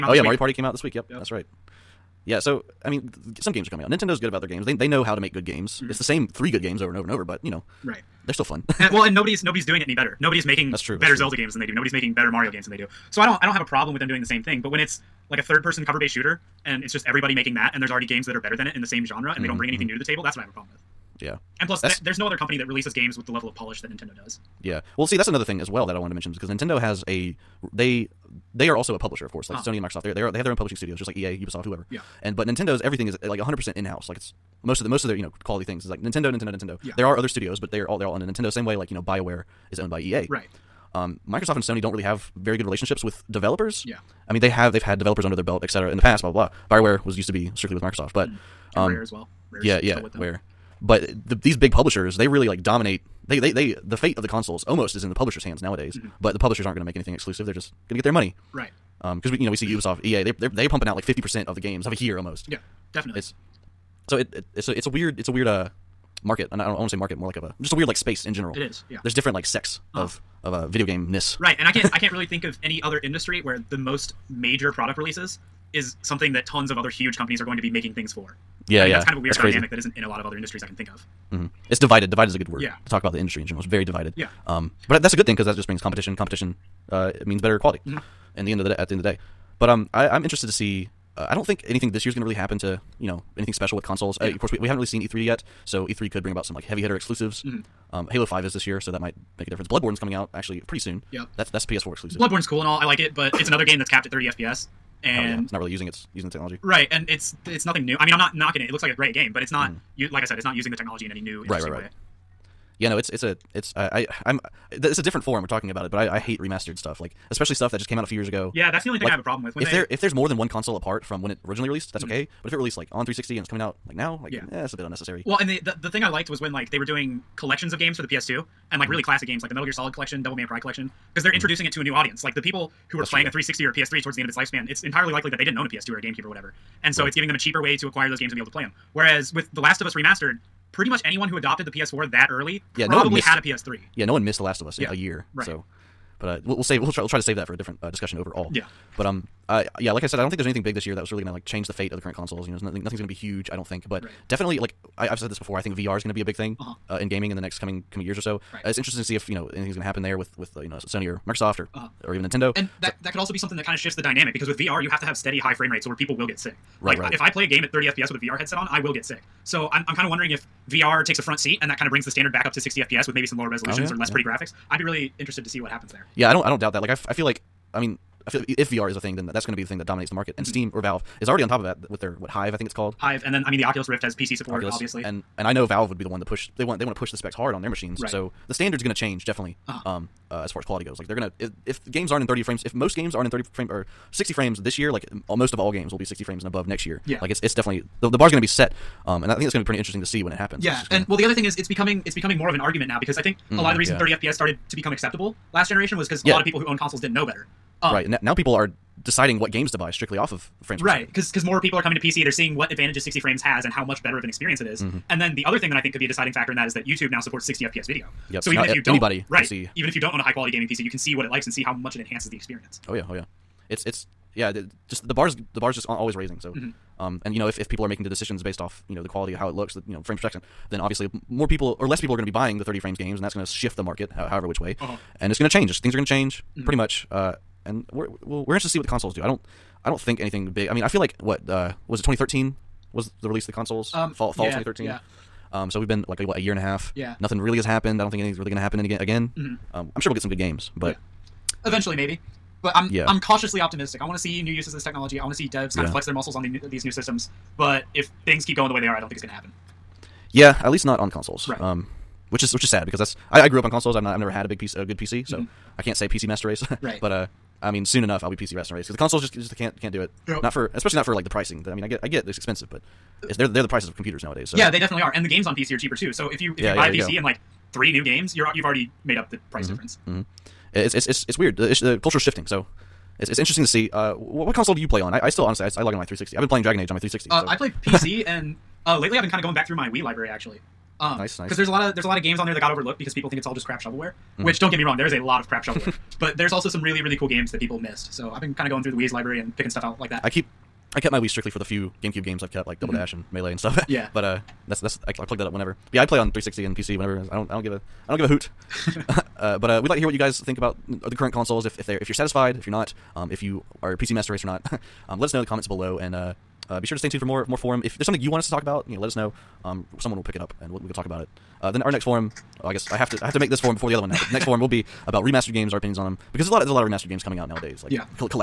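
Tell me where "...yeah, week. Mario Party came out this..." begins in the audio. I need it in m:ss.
0:00.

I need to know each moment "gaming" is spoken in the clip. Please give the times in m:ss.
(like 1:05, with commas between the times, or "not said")
2:37, 3:40.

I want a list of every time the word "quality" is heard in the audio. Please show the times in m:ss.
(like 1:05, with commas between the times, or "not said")
0:35, 1:27, 3:10, 3:40, 3:49.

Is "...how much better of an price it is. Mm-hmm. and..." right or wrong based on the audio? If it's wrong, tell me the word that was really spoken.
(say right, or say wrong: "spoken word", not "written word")
wrong: "experience", not "price".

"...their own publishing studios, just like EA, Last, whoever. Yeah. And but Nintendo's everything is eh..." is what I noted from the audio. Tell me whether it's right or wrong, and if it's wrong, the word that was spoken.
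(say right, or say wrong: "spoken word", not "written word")
wrong: "Ubisoft", not "Last".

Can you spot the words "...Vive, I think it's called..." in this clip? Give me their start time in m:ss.
3:02.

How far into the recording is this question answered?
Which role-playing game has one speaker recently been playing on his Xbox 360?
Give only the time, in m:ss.
4:46.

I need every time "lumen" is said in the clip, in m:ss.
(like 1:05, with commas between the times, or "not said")
not said.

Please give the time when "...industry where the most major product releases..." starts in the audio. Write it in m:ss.
1:12.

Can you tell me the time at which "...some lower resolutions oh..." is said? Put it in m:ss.
2:53.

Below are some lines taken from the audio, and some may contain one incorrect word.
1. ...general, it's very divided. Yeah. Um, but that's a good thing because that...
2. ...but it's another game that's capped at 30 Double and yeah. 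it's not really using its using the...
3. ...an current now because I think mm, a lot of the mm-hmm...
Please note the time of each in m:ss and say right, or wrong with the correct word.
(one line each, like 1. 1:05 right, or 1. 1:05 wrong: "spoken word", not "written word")
1. 1:23 right
2. 1:43 wrong: "FPS", not "Double"
3. 3:22 wrong: "argument", not "current".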